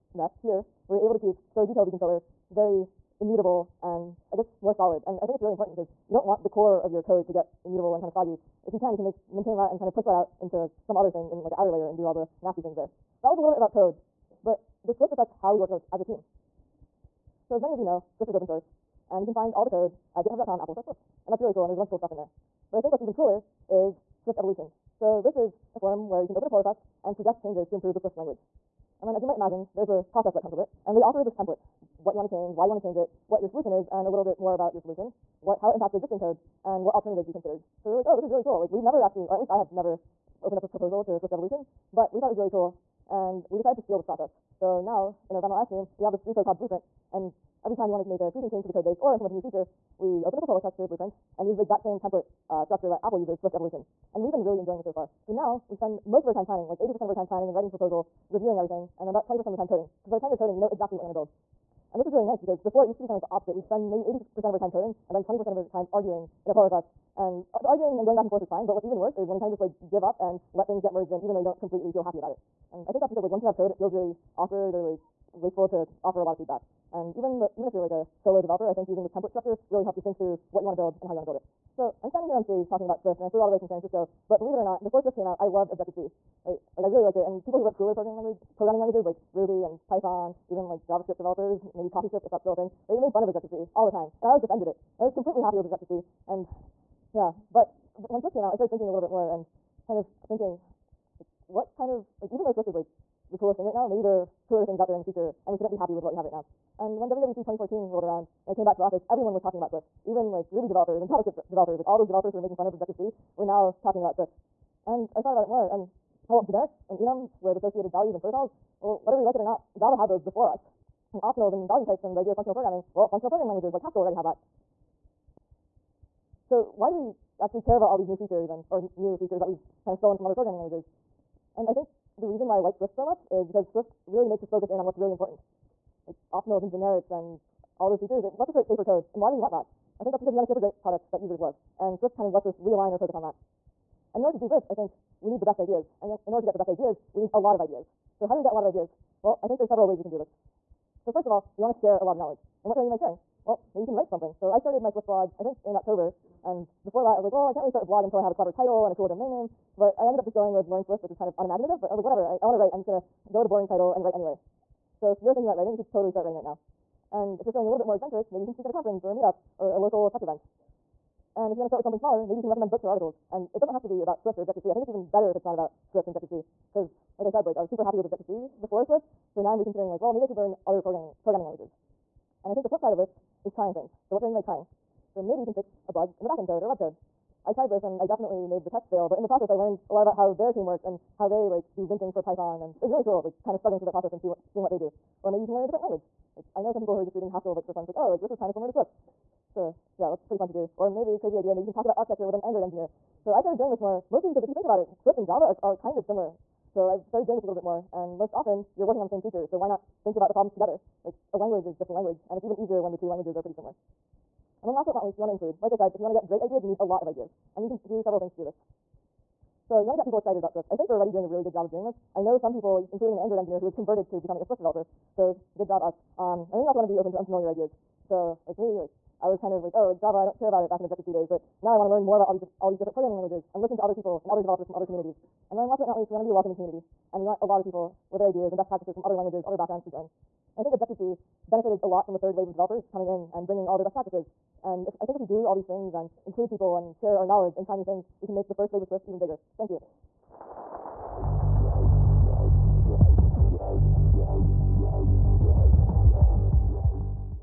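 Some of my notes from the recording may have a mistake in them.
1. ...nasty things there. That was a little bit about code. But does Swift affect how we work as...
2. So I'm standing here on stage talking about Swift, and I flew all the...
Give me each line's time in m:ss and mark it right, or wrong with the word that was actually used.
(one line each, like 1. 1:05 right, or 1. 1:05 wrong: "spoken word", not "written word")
1. 0:12 right
2. 1:21 right.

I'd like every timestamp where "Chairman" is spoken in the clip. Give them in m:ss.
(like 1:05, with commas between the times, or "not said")
not said.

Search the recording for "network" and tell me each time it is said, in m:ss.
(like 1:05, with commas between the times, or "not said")
not said.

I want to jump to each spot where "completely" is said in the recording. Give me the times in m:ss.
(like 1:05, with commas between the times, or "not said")
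1:11, 1:35.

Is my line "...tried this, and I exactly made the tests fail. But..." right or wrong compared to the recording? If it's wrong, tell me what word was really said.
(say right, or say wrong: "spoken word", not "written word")
wrong: "definitely", not "exactly".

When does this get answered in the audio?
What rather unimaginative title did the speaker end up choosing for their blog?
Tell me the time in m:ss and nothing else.
2:40.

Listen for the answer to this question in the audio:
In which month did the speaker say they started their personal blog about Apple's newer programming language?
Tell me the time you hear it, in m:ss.
2:35.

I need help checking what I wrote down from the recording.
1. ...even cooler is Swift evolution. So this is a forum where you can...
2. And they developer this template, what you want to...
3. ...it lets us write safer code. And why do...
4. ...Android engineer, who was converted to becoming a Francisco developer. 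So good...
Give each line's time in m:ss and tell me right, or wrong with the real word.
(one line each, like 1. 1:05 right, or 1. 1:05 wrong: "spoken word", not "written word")
1. 0:23 right
2. 0:30 wrong: "offer", not "developer"
3. 2:18 right
4. 3:43 wrong: "Swift", not "Francisco".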